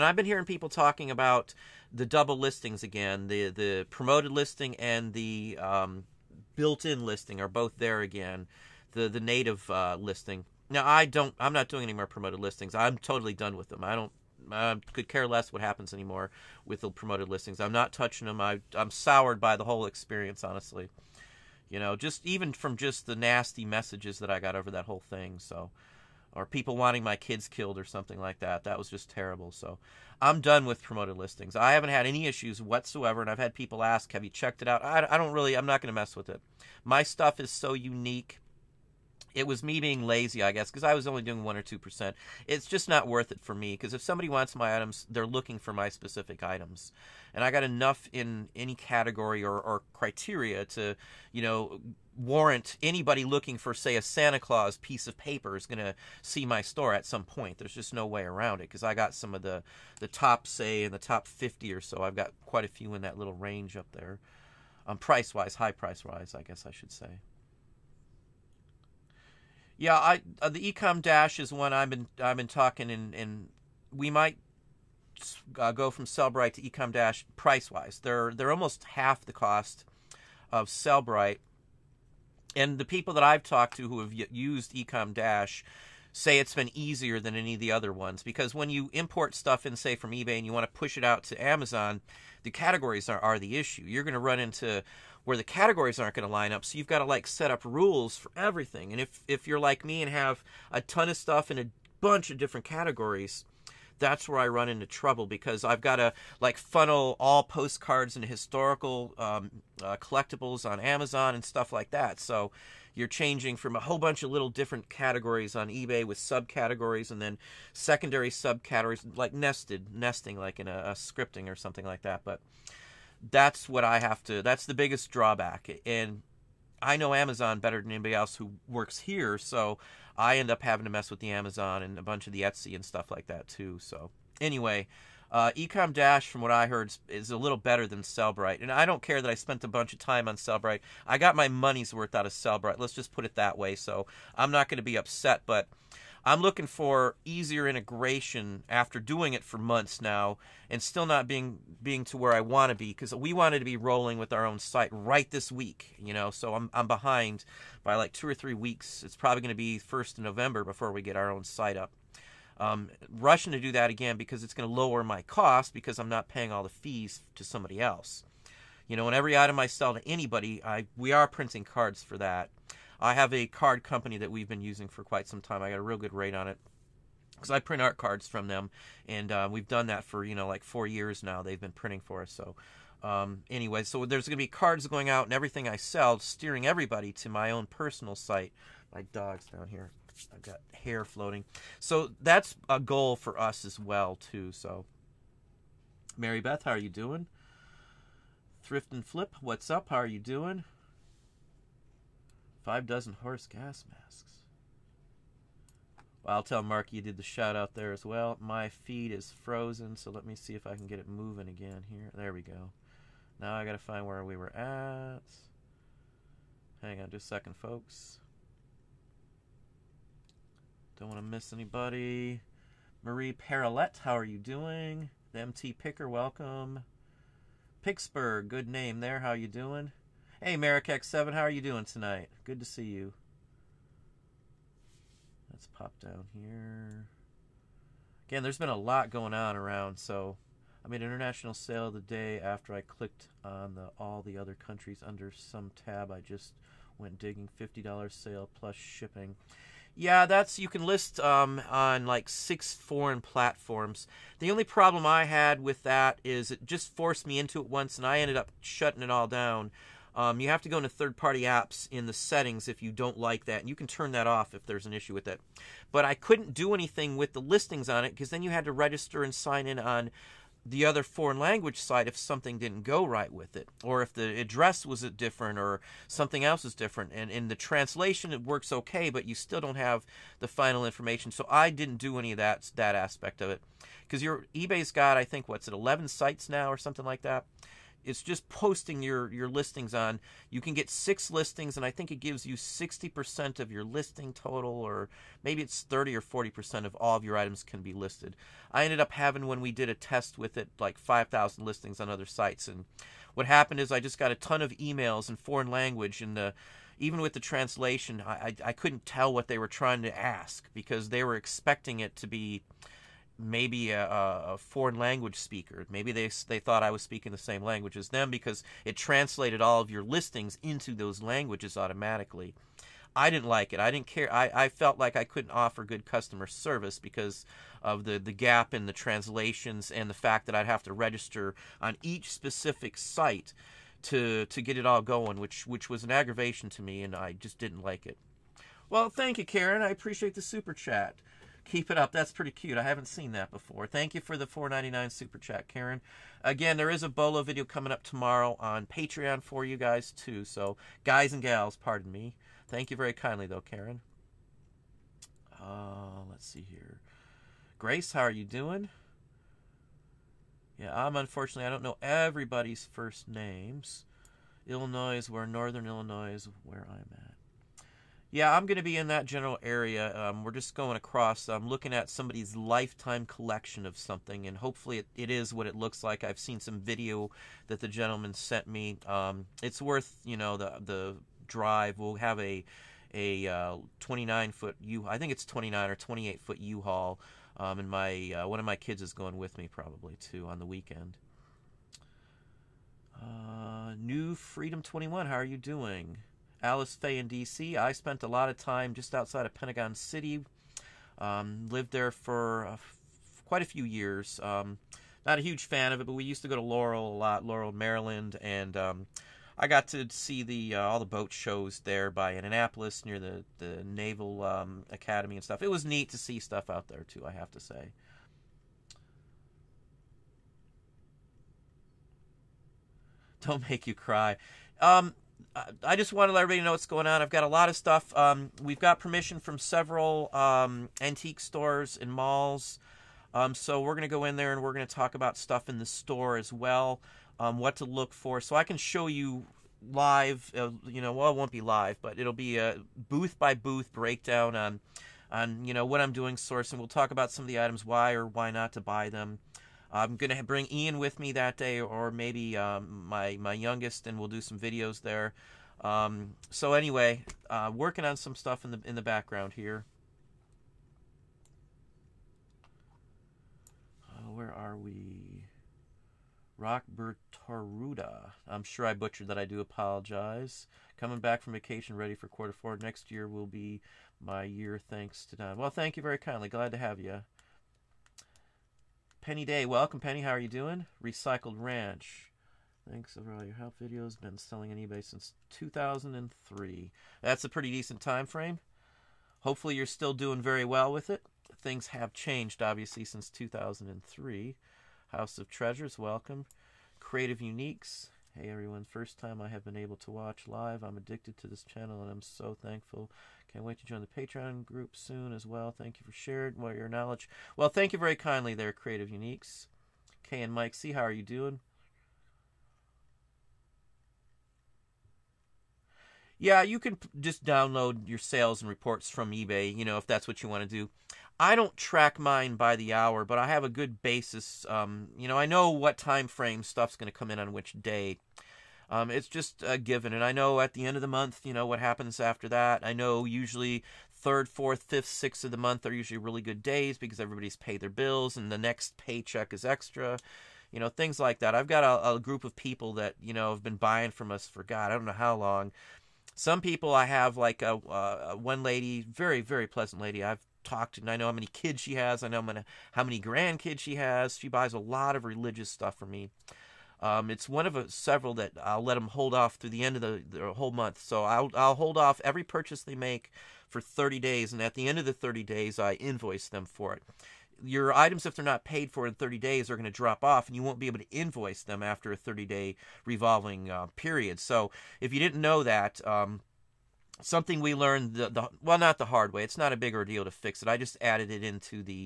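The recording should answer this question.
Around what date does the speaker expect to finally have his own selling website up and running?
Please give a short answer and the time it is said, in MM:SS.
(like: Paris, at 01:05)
first of November, at 02:39.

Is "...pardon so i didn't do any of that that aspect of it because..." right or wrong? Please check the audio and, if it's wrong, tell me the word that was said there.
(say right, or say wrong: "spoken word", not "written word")
wrong: "information", not "pardon".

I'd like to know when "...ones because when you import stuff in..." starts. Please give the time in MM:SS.
01:27.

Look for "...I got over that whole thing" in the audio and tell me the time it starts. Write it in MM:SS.
00:24.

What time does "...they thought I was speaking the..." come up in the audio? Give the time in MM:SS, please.
05:16.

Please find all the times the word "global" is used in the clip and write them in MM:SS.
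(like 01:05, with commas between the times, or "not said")
not said.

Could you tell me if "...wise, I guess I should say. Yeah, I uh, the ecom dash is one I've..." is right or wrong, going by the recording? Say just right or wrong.
right.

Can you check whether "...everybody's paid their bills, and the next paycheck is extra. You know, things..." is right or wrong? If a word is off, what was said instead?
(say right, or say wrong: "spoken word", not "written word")
right.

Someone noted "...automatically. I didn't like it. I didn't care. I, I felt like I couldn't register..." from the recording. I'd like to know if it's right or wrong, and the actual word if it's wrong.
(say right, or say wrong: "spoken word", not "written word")
wrong: "offer", not "register".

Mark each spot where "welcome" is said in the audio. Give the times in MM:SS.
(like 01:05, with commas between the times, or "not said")
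03:46, 07:59, 08:15.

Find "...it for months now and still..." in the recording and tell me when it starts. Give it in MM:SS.
02:29.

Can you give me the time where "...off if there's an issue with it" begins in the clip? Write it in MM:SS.
04:24.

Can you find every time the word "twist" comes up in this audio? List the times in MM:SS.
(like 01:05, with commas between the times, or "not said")
not said.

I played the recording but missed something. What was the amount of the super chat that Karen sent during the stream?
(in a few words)
4.99.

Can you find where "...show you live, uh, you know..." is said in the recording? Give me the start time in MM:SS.
07:18.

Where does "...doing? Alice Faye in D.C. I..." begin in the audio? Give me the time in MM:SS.
06:35.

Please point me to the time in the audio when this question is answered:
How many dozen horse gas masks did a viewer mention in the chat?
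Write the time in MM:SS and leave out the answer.
03:22.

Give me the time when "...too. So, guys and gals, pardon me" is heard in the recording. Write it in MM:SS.
05:50.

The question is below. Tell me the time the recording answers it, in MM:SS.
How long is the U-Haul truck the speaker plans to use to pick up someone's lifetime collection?
06:23.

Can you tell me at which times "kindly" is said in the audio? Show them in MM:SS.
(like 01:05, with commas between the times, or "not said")
05:53, 07:56, 08:28.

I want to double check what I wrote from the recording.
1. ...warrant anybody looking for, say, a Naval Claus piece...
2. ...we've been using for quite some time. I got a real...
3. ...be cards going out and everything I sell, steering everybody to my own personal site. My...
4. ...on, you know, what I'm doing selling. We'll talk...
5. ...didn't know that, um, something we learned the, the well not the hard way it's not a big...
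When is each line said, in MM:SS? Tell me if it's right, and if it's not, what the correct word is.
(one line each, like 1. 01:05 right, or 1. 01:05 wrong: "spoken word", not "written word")
1. 00:52 wrong: "Santa", not "Naval"
2. 02:54 right
3. 03:04 right
4. 07:25 wrong: "sourcing", not "selling"
5. 09:35 right.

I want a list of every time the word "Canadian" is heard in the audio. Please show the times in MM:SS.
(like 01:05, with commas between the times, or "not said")
not said.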